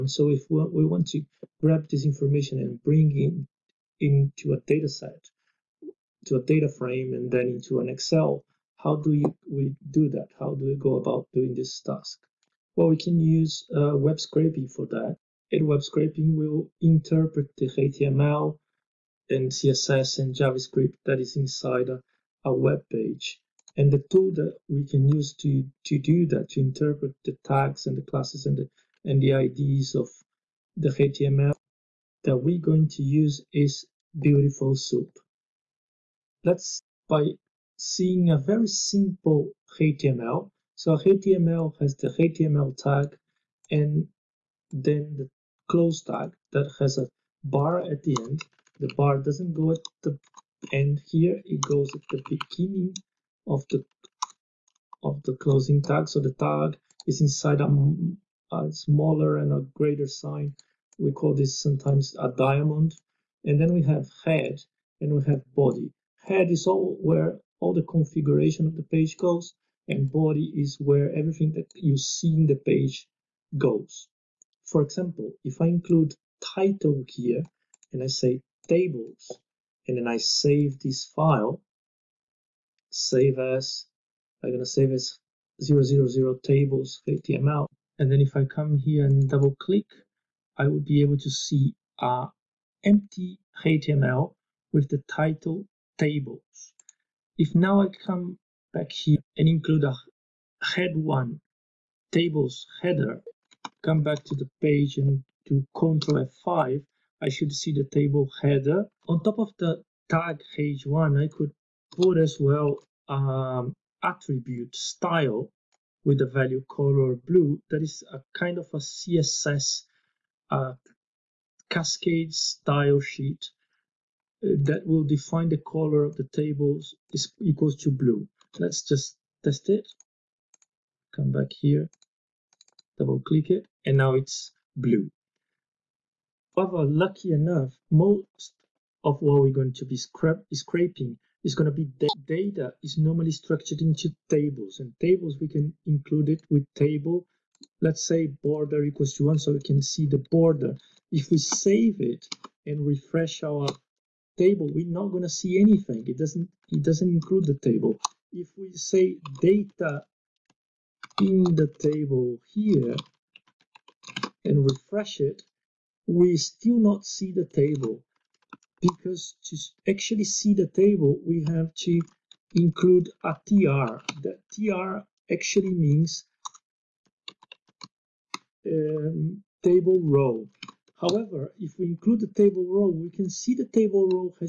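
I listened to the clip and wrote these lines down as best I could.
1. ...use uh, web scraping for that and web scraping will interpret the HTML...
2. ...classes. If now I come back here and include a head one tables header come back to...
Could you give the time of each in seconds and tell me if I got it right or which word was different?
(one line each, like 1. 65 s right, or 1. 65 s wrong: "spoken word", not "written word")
1. 13 s right
2. 95 s wrong: "tables", not "classes".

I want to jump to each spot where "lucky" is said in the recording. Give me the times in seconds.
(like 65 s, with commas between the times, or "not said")
136 s.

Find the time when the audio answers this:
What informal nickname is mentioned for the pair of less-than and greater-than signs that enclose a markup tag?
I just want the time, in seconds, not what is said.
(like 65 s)
62 s.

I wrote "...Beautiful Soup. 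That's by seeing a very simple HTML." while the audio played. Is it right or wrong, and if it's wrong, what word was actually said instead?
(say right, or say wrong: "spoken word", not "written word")
right.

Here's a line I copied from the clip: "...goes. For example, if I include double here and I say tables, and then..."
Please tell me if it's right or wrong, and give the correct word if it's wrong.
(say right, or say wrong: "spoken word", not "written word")
wrong: "title", not "double".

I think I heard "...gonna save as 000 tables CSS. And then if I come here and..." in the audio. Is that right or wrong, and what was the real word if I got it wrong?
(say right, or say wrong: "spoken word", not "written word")
wrong: "HTML", not "CSS".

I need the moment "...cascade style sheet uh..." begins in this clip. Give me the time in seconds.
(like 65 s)
121 s.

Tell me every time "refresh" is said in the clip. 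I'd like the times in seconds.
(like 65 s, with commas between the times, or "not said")
152 s, 164 s.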